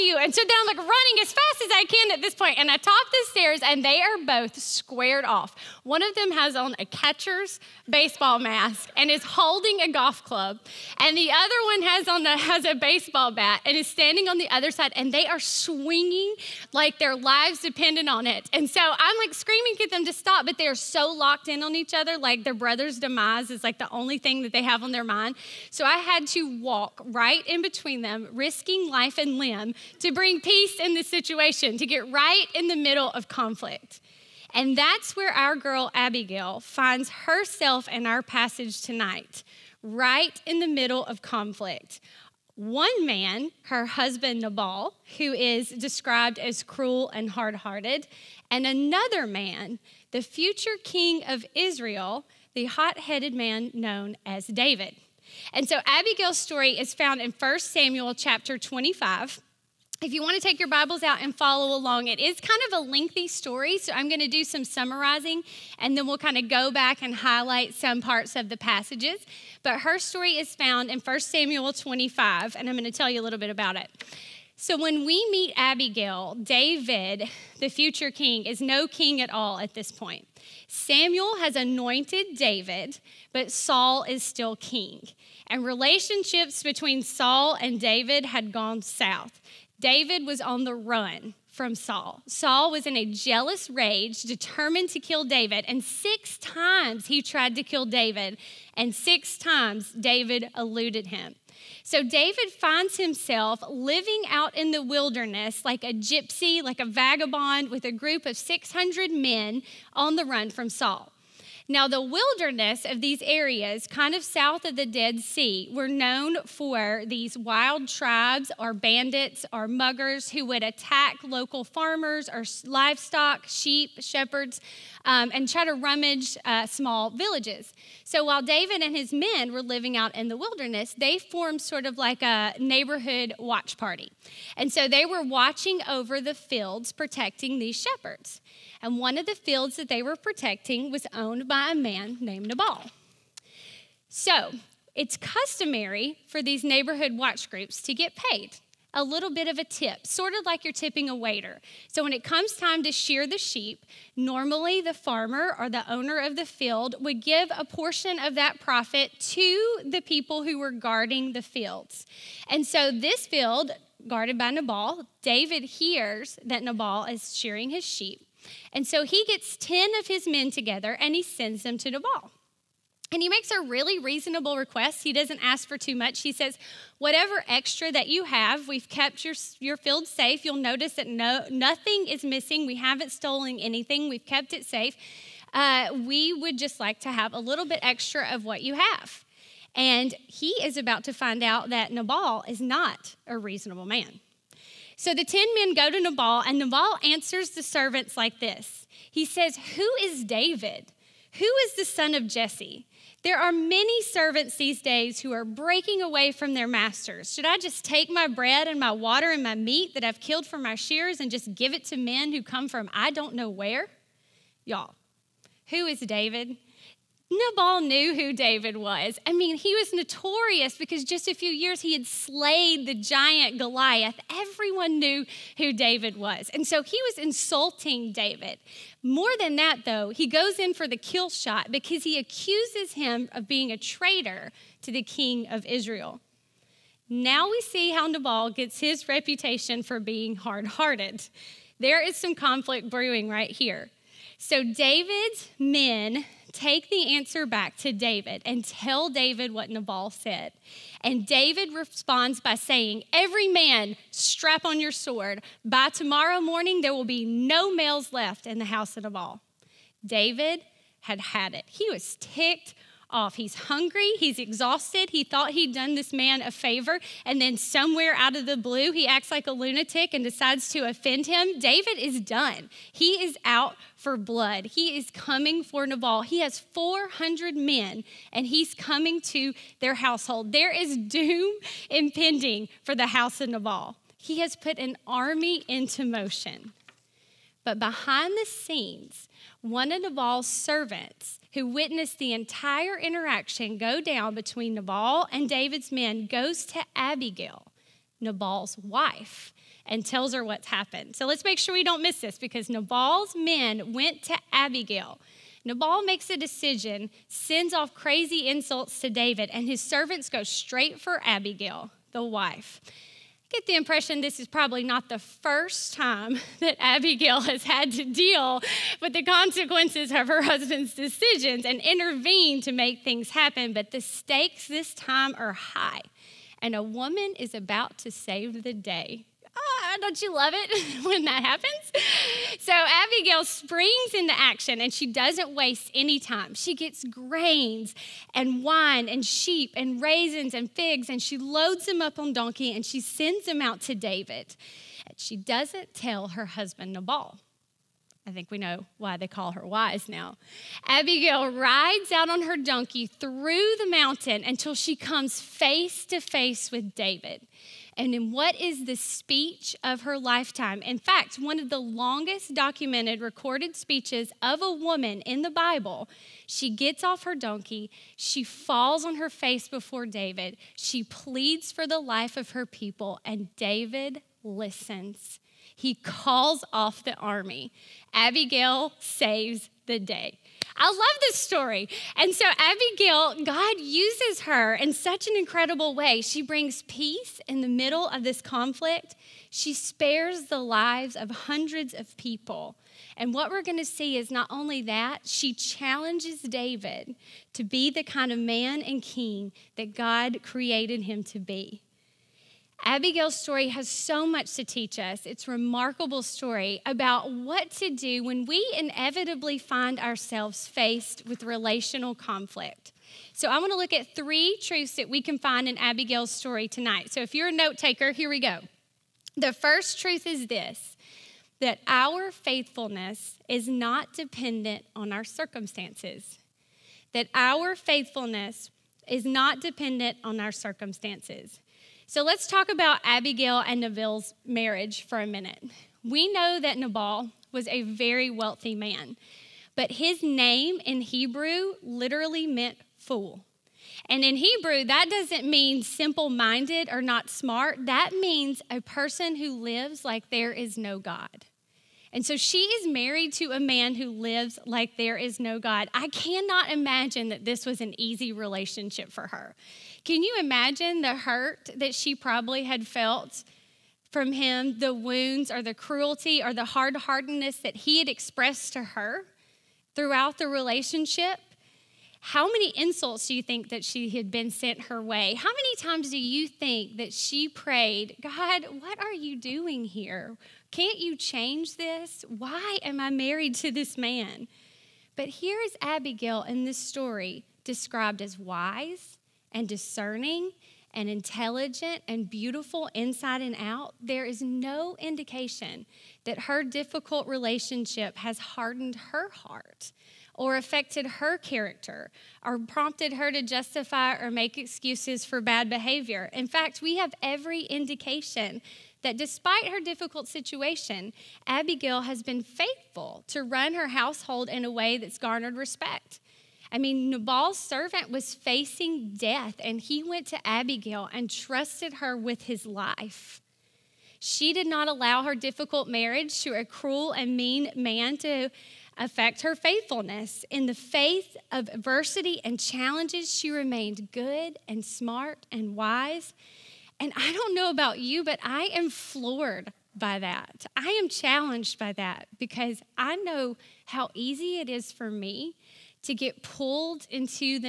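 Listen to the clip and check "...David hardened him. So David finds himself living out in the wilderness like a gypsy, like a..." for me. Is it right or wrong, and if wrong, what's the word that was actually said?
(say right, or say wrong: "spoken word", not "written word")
wrong: "eluded", not "hardened".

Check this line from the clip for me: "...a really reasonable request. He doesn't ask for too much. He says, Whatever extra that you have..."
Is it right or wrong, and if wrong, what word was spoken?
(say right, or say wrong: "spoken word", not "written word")
right.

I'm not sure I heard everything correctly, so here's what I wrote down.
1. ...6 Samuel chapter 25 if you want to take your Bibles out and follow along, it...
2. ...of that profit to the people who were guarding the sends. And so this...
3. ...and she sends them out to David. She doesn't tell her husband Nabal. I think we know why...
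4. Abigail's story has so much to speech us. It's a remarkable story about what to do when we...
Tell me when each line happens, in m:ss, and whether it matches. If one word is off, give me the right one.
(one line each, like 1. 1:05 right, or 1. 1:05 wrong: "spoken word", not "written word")
1. 0:57 wrong: "1", not "6"
2. 2:38 wrong: "fields", not "sends"
3. 5:42 right
4. 6:42 wrong: "teach", not "speech".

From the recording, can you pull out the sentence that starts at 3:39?
I mean, he was notorious because just a few years he had slayed the giant Goliath.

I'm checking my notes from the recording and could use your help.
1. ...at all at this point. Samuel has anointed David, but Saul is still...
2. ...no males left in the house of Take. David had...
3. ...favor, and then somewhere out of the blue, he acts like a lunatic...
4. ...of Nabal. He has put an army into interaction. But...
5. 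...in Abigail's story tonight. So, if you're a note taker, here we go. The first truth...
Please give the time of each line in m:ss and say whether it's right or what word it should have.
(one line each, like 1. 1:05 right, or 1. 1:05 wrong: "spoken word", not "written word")
1. 1:19 right
2. 4:17 wrong: "Nabal", not "Take"
3. 4:26 right
4. 4:43 wrong: "motion", not "interaction"
5. 6:55 right.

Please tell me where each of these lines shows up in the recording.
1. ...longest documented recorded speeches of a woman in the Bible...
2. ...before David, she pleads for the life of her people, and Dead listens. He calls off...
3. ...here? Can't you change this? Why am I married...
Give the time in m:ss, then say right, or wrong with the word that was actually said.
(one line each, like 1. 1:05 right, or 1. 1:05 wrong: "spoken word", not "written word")
1. 6:01 right
2. 6:09 wrong: "David", not "Dead"
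3. 7:59 right.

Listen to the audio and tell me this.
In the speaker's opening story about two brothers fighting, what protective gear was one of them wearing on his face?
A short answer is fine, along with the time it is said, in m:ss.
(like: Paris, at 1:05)
catcher's baseball mask, at 0:06.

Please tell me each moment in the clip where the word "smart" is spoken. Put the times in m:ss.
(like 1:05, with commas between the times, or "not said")
7:27, 8:54.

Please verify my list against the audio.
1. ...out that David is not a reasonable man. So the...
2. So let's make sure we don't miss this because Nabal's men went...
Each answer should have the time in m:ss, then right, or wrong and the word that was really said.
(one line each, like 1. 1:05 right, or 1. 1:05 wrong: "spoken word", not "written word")
1. 3:11 wrong: "Nabal", not "David"
2. 5:01 right.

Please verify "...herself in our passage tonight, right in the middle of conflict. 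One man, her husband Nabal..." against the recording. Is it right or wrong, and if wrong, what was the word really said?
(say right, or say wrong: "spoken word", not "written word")
right.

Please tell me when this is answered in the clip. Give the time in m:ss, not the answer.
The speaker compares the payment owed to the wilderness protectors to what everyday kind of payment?
2:30.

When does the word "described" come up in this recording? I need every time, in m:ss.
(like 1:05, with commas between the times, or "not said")
0:45, 8:07.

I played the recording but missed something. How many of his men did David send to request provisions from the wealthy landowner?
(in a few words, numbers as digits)
10.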